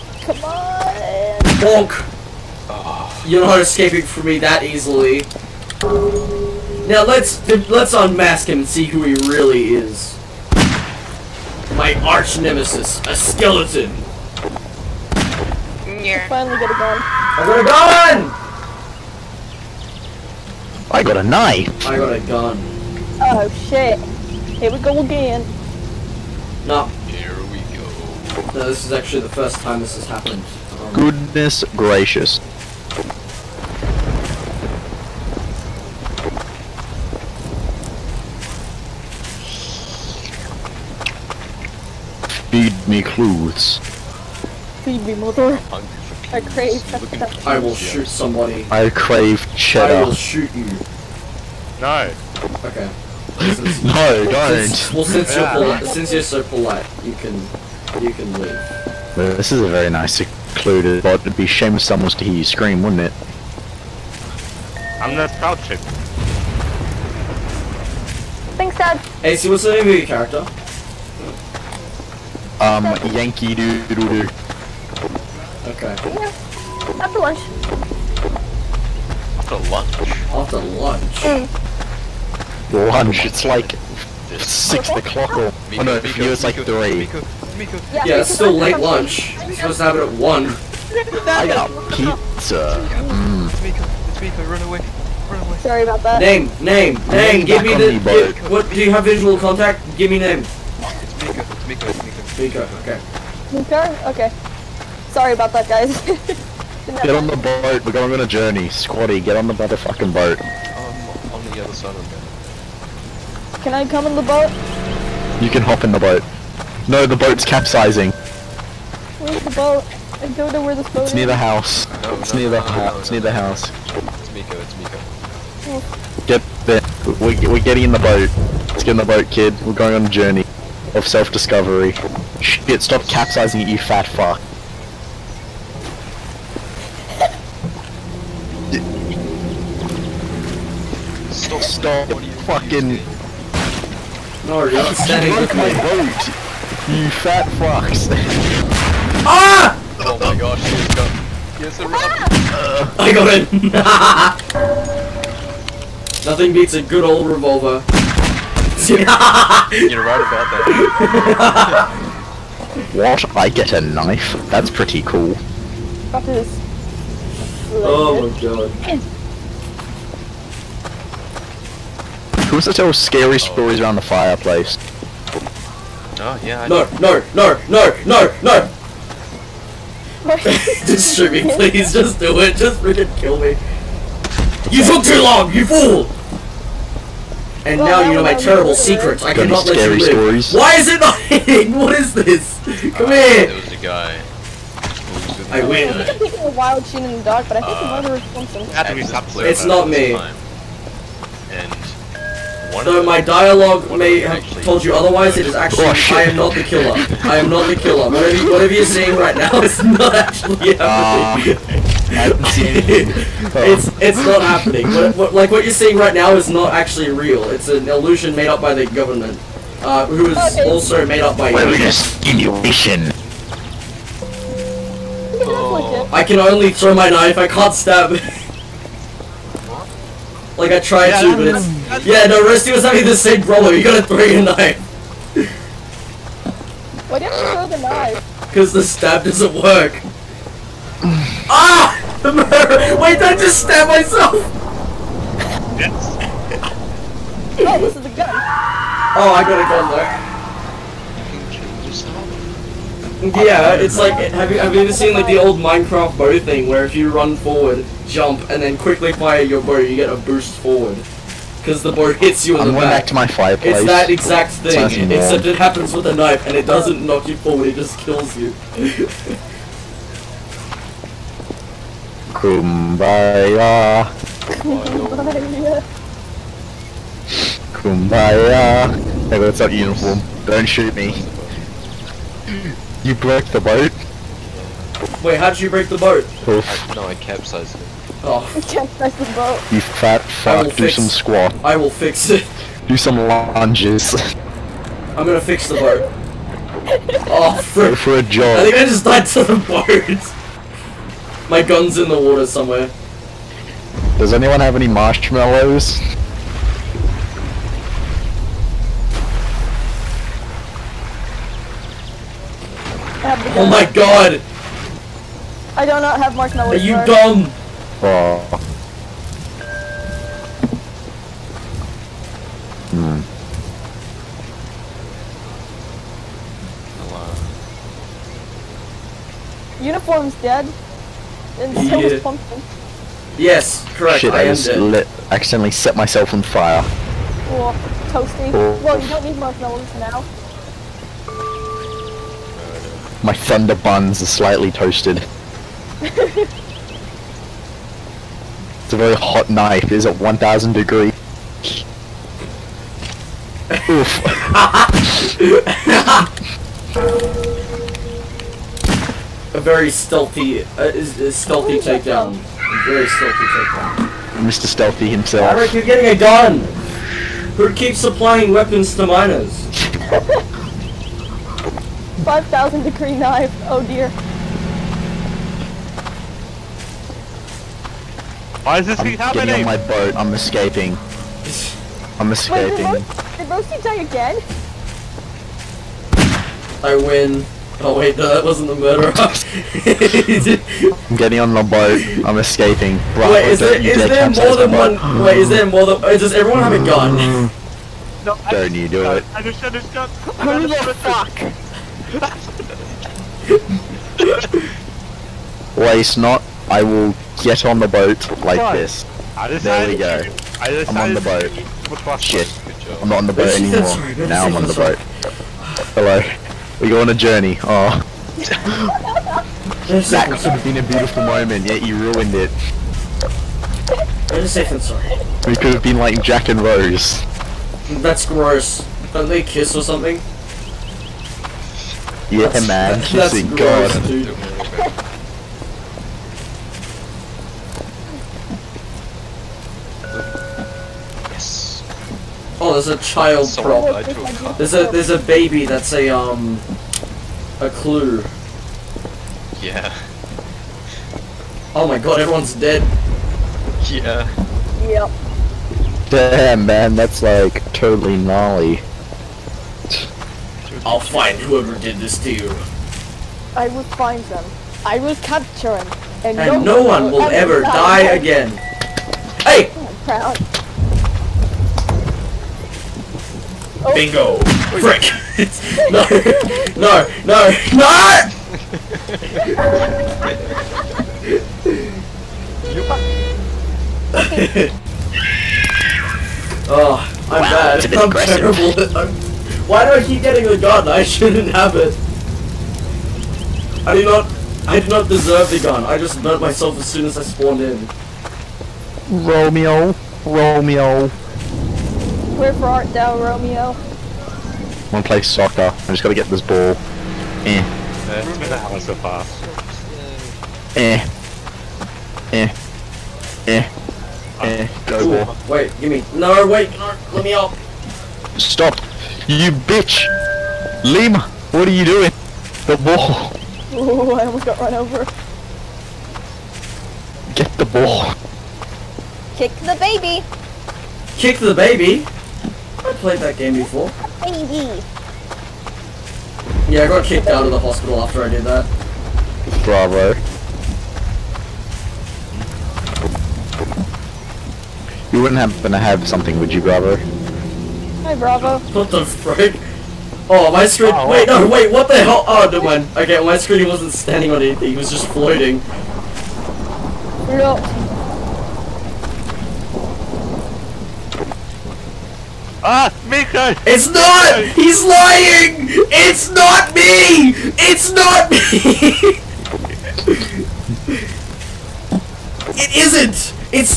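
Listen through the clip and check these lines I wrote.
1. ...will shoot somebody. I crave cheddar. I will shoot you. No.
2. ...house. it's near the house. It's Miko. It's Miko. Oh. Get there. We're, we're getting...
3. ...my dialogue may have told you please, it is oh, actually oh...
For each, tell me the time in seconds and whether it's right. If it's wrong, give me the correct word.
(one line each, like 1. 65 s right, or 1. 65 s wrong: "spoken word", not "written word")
1. 47 s right
2. 122 s right
3. 203 s wrong: "otherwise", not "please".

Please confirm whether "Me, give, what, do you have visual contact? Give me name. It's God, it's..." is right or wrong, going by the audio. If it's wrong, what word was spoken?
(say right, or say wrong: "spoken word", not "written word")
wrong: "Miko", not "God".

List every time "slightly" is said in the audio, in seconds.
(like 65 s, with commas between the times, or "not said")
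344 s.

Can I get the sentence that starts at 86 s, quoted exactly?
Yeah, yeah it's still late lunch.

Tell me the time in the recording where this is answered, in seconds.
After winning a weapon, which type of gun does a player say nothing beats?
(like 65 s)
157 s.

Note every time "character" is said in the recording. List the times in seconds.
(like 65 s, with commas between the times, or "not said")
70 s.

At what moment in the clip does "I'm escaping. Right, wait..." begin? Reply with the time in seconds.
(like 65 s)
392 s.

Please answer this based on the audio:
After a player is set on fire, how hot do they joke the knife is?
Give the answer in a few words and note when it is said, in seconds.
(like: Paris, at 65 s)
5,000 degrees, at 372 s.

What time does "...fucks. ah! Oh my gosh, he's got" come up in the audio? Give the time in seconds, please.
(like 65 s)
147 s.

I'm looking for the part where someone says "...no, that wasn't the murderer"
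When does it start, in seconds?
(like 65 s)
388 s.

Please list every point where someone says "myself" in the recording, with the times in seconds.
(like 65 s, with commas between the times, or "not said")
243 s, 335 s, 496 s.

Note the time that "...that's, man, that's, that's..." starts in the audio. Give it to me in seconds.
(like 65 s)
432 s.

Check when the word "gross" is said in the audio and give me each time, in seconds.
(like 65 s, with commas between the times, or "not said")
428 s.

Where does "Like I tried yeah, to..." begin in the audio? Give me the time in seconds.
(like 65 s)
230 s.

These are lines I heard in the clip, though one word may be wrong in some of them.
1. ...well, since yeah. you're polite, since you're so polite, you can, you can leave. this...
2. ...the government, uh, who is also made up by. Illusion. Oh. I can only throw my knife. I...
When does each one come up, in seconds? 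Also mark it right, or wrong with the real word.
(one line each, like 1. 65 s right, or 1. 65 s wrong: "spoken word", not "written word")
1. 54 s right
2. 218 s right.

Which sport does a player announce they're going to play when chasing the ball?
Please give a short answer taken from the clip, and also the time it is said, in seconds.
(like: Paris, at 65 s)
soccer, at 505 s.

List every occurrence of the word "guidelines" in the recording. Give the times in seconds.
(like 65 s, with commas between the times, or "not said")
not said.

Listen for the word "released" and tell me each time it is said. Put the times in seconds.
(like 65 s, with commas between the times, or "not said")
not said.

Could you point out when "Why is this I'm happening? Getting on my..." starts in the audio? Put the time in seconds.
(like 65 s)
378 s.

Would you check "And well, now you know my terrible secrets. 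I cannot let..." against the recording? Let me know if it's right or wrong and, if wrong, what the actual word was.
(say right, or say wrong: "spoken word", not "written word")
right.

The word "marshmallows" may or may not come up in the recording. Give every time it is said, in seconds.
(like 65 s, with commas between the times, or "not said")
304 s, 316 s, 339 s.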